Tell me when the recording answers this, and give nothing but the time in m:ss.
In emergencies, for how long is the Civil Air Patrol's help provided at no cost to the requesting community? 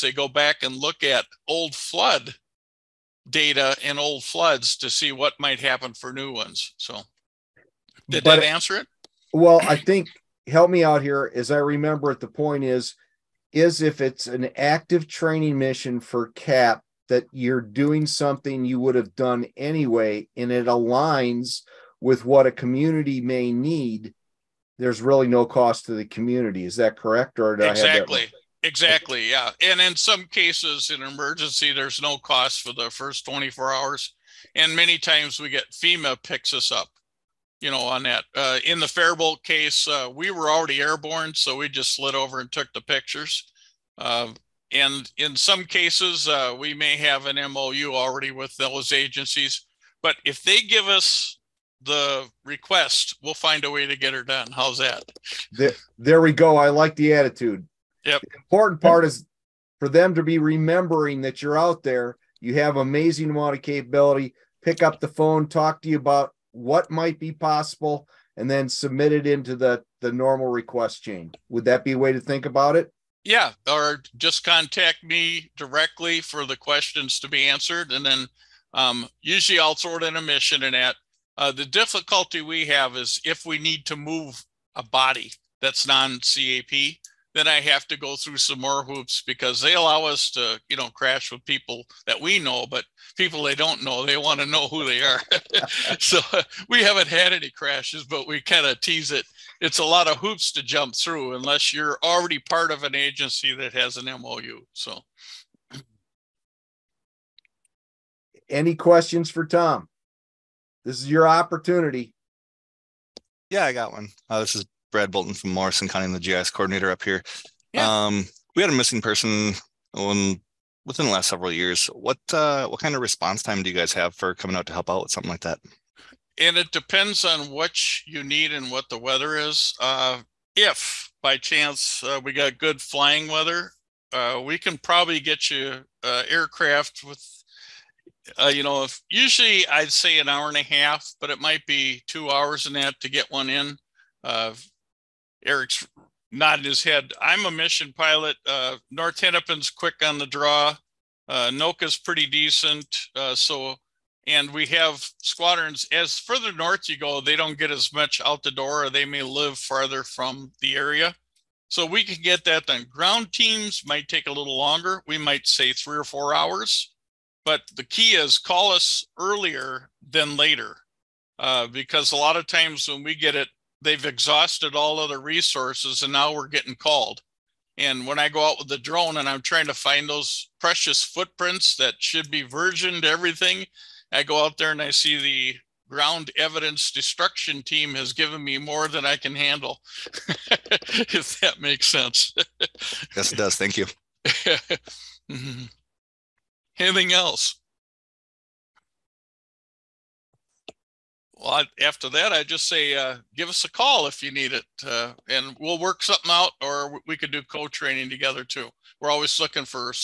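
0:32.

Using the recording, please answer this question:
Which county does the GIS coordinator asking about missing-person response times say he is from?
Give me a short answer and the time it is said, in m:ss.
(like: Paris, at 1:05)
Morrison County, at 1:55.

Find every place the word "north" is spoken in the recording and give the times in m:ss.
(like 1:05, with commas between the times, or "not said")
2:28, 2:36.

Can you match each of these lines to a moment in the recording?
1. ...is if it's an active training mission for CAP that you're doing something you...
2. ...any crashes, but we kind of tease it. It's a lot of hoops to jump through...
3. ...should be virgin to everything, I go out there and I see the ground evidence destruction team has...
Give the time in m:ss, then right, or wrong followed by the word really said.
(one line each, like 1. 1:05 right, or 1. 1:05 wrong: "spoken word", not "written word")
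1. 0:13 right
2. 1:37 right
3. 3:01 right.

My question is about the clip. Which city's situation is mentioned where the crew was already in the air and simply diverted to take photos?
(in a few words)
Faribault.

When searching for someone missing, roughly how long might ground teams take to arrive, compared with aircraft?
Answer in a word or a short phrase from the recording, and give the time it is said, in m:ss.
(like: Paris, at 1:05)
3 or 4 hours, at 2:45.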